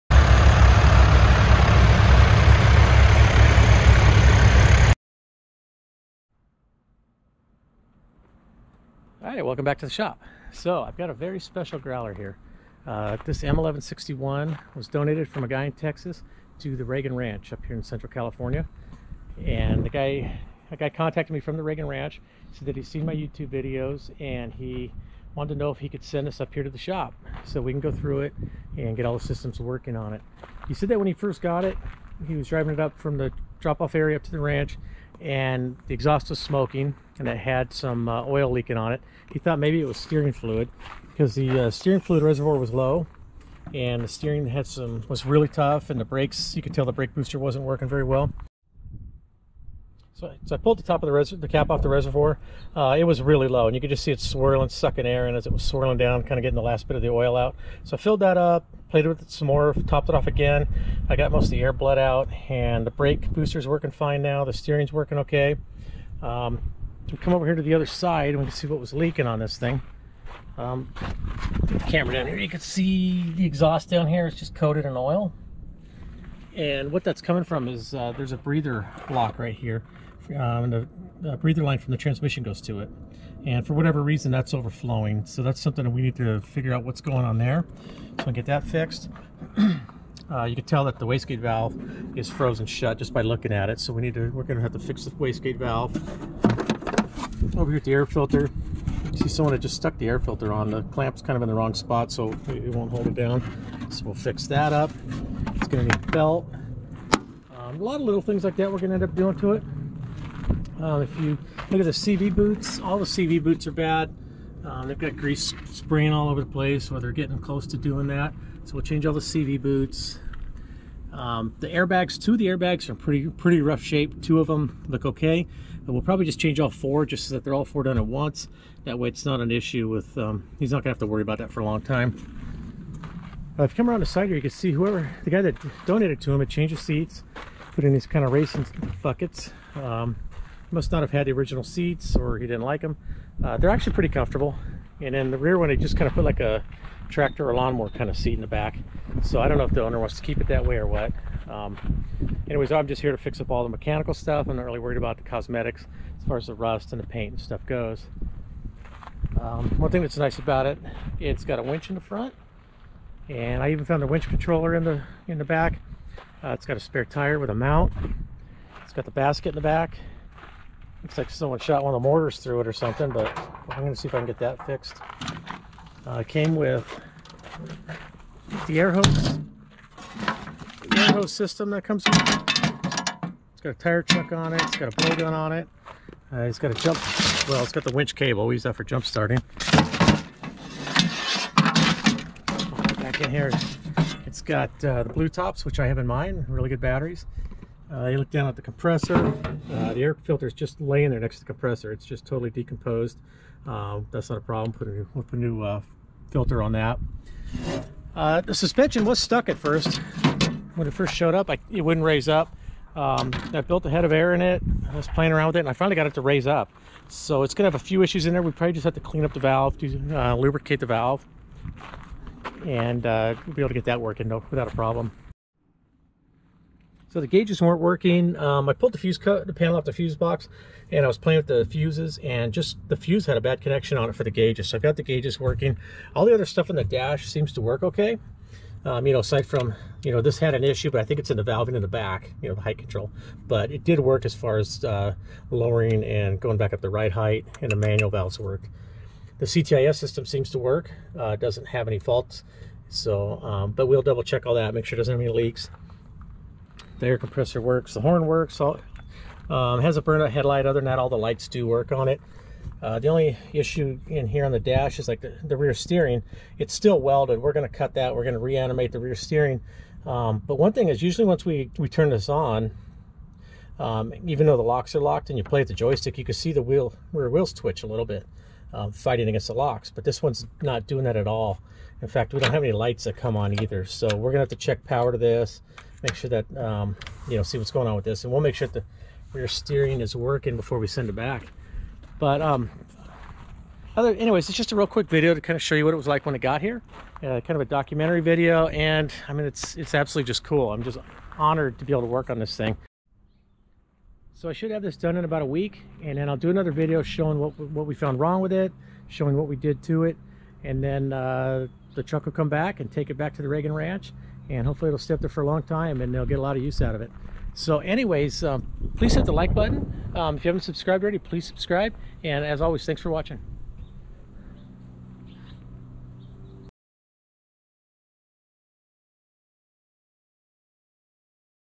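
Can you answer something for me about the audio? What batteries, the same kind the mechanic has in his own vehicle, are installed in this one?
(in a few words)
blue tops.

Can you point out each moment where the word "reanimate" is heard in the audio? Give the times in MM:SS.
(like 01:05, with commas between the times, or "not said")
04:28.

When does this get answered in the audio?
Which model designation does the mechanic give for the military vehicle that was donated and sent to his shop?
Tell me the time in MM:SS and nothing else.
00:13.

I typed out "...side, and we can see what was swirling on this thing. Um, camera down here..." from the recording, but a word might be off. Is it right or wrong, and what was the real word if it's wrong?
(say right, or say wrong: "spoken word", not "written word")
wrong: "leaking", not "swirling".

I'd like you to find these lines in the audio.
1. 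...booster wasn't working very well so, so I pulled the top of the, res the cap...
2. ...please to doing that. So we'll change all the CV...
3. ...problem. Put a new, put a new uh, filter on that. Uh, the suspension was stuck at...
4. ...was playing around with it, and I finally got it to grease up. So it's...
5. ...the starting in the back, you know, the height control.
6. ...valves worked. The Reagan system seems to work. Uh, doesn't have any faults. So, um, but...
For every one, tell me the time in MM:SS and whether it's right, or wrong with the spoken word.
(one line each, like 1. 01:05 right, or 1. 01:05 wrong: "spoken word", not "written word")
1. 00:47 right
2. 01:57 wrong: "close", not "please"
3. 03:24 right
4. 03:34 wrong: "raise", not "grease"
5. 04:01 wrong: "valving", not "starting"
6. 04:08 wrong: "CTIS", not "Reagan".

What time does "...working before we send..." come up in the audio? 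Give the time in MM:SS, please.
04:50.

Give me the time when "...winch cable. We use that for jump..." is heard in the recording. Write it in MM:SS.
03:07.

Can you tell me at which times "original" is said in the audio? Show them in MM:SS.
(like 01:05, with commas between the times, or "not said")
02:21.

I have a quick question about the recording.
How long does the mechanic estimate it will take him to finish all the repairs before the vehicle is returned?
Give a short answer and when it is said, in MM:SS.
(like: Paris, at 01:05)
about a week, at 05:05.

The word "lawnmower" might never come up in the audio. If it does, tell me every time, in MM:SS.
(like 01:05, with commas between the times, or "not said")
02:27.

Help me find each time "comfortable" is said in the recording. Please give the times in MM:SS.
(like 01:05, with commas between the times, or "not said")
02:24.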